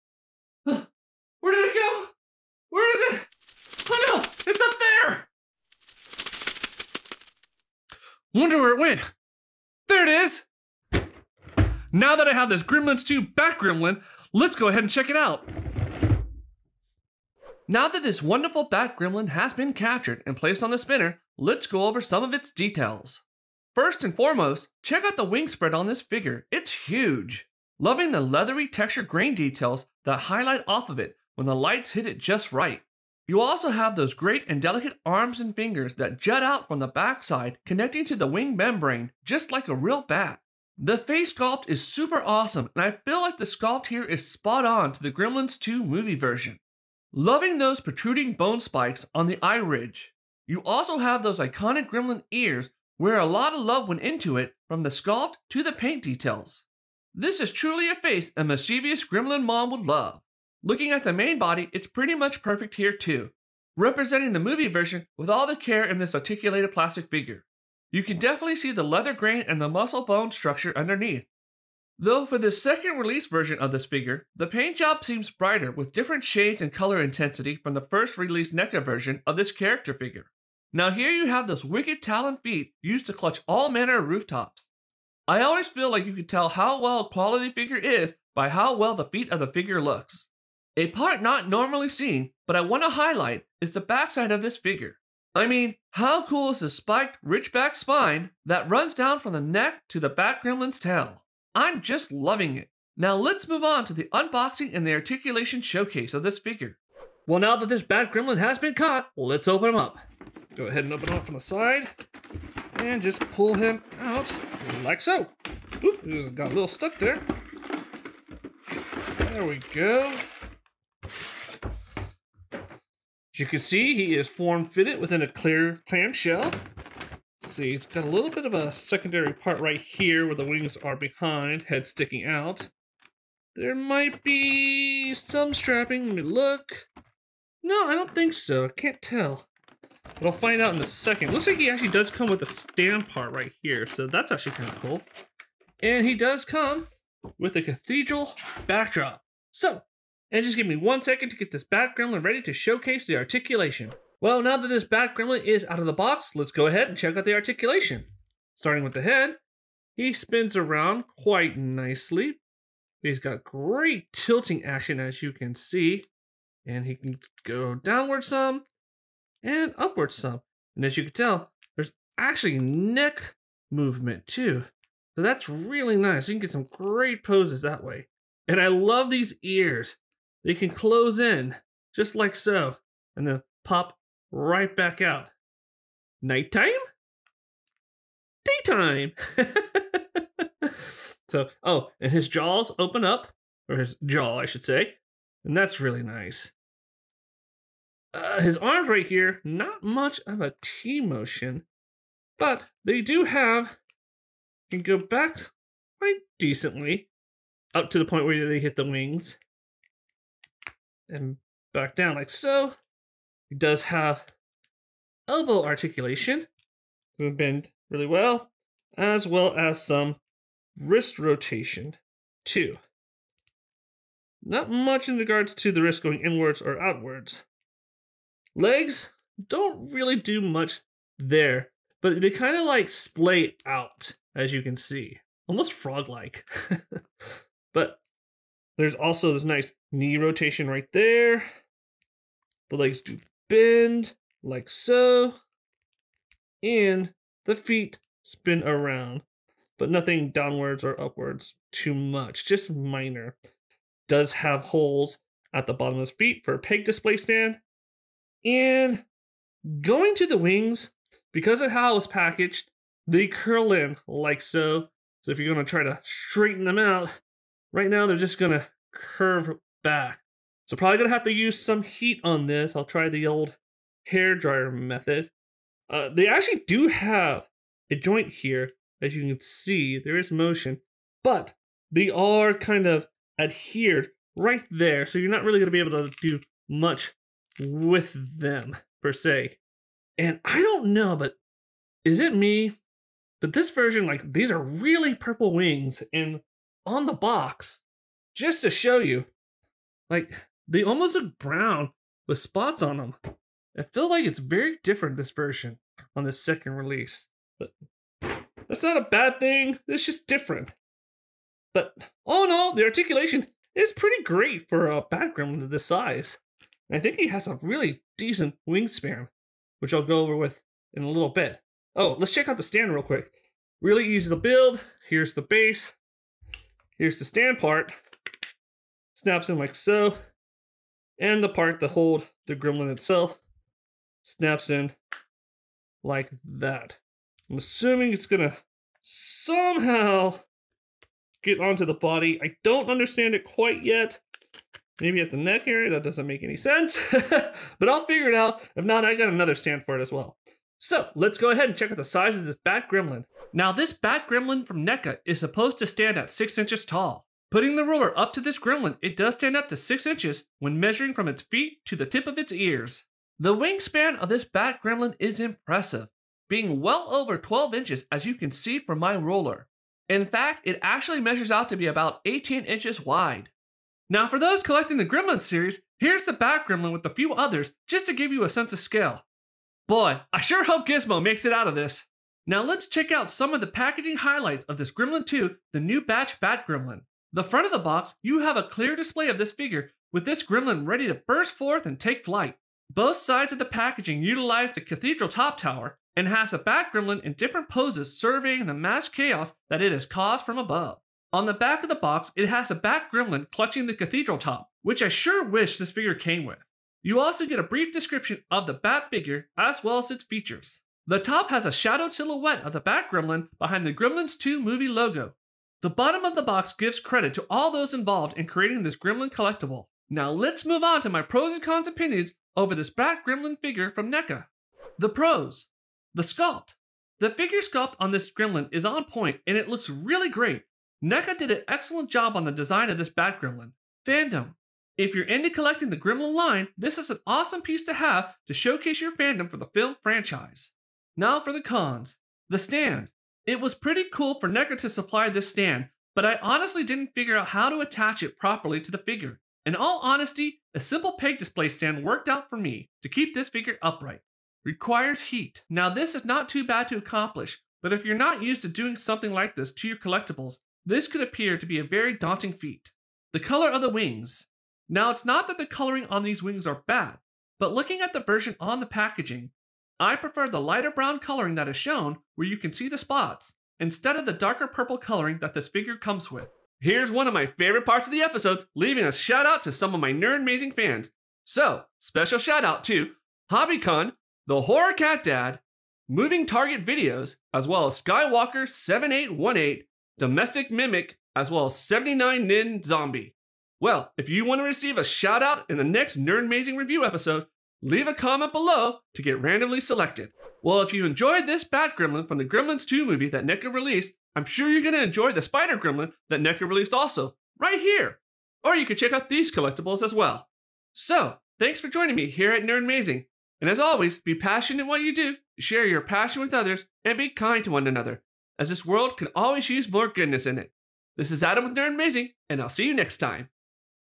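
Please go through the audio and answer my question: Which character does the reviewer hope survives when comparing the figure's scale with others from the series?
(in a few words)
Gizmo.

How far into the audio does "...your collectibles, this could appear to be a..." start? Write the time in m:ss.
7:39.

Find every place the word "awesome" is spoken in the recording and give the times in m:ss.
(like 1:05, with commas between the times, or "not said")
0:42, 7:17.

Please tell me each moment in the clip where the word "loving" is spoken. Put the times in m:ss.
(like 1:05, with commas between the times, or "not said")
0:27, 0:47, 1:42.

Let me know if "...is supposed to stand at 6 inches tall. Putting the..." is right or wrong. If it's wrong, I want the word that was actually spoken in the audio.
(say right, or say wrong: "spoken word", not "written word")
right.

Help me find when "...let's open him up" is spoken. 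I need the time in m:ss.
1:49.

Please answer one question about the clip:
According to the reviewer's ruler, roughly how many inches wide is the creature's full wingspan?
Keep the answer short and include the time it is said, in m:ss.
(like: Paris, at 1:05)
18 inches, at 6:12.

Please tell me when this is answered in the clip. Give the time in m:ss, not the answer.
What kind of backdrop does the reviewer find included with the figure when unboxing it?
2:27.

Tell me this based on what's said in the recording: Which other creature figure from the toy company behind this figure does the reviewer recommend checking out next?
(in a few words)
Spider Gremlin.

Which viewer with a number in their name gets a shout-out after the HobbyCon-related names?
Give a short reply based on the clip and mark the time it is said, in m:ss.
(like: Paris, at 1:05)
Skywalker7818, at 8:08.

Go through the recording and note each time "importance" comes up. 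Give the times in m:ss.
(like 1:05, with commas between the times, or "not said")
not said.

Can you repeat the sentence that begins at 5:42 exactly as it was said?
I don't understand it quite yet.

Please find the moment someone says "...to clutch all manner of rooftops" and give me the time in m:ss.
1:23.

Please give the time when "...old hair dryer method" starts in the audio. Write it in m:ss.
4:33.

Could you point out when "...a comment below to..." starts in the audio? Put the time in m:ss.
8:18.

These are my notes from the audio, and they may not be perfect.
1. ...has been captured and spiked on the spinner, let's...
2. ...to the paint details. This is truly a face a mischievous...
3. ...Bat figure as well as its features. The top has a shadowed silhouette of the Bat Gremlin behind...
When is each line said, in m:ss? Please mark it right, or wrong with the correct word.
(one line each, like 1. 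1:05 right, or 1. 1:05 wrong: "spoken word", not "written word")
1. 0:19 wrong: "placed", not "spiked"
2. 0:55 right
3. 6:48 right.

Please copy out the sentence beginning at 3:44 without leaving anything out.
Not much in regards to the wrist going inwards or outwards.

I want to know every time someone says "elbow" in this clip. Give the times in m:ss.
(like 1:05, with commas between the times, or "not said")
3:35.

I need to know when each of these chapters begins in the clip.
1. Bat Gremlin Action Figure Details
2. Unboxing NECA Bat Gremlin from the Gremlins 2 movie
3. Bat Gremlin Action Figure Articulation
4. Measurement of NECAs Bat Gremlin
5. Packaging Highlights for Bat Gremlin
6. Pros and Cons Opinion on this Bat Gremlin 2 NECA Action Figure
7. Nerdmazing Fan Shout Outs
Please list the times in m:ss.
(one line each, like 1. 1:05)
1. 0:17
2. 1:47
3. 2:34
4. 5:53
5. 6:22
6. 7:04
7. 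7:58.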